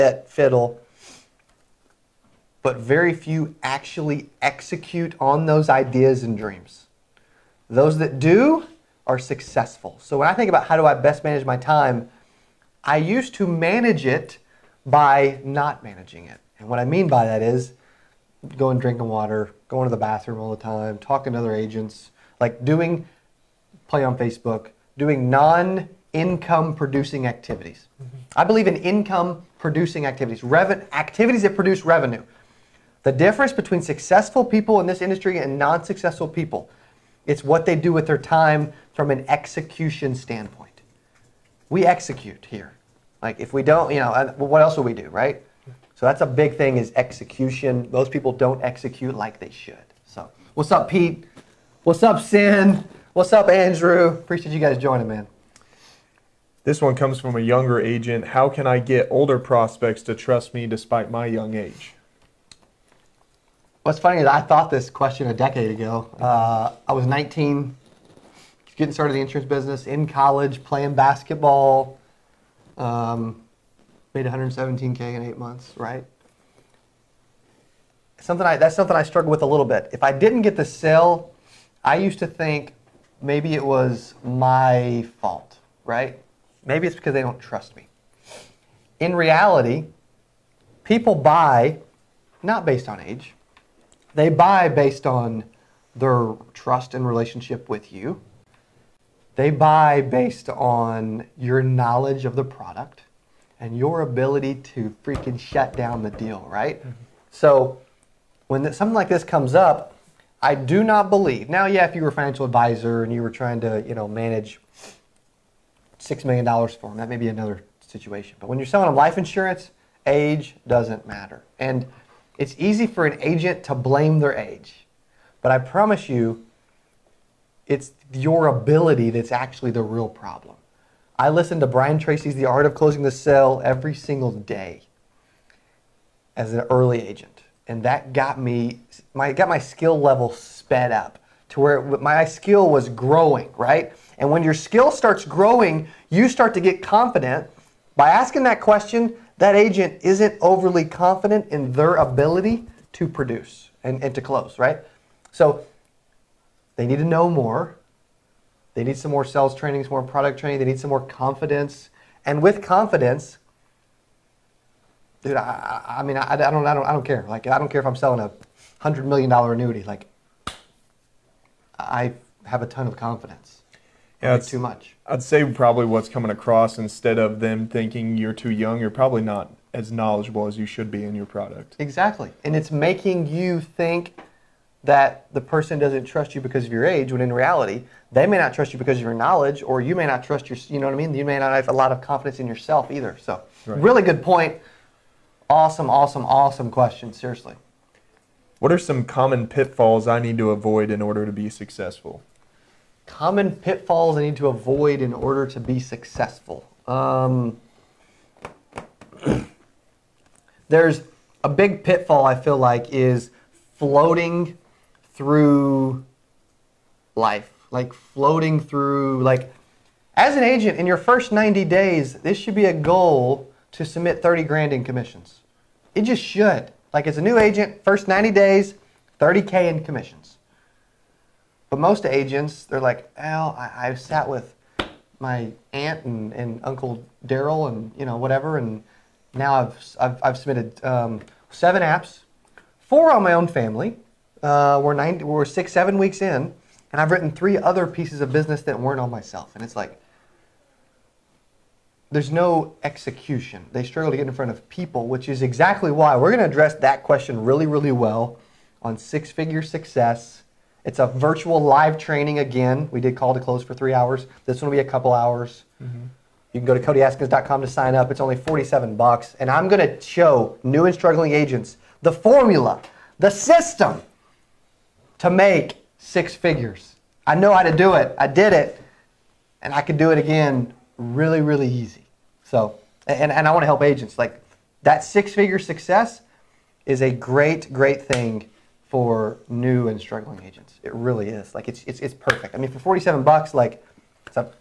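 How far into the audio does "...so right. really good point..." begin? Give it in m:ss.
3:13.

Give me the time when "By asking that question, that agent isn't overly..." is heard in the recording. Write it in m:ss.
2:27.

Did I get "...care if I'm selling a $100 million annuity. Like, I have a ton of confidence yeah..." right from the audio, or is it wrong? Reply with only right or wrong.
right.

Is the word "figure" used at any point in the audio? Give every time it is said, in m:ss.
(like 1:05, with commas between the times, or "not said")
4:19, 4:36, 4:45.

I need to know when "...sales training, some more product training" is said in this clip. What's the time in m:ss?
2:39.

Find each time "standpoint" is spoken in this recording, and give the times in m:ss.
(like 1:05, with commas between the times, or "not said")
0:40.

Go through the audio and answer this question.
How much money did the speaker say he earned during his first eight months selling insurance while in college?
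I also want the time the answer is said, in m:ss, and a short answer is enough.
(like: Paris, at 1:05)
$117k, at 1:14.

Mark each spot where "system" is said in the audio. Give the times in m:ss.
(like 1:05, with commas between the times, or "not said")
4:33.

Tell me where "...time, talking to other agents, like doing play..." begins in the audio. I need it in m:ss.
0:20.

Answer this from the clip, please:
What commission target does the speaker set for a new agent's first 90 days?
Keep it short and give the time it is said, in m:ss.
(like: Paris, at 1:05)
$30k, at 3:44.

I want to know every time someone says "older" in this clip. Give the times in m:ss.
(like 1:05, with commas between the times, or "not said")
0:59.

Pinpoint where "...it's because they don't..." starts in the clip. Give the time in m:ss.
1:26.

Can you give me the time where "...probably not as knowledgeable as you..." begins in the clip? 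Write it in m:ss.
2:58.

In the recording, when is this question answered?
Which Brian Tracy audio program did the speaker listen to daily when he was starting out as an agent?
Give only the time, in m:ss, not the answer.
2:12.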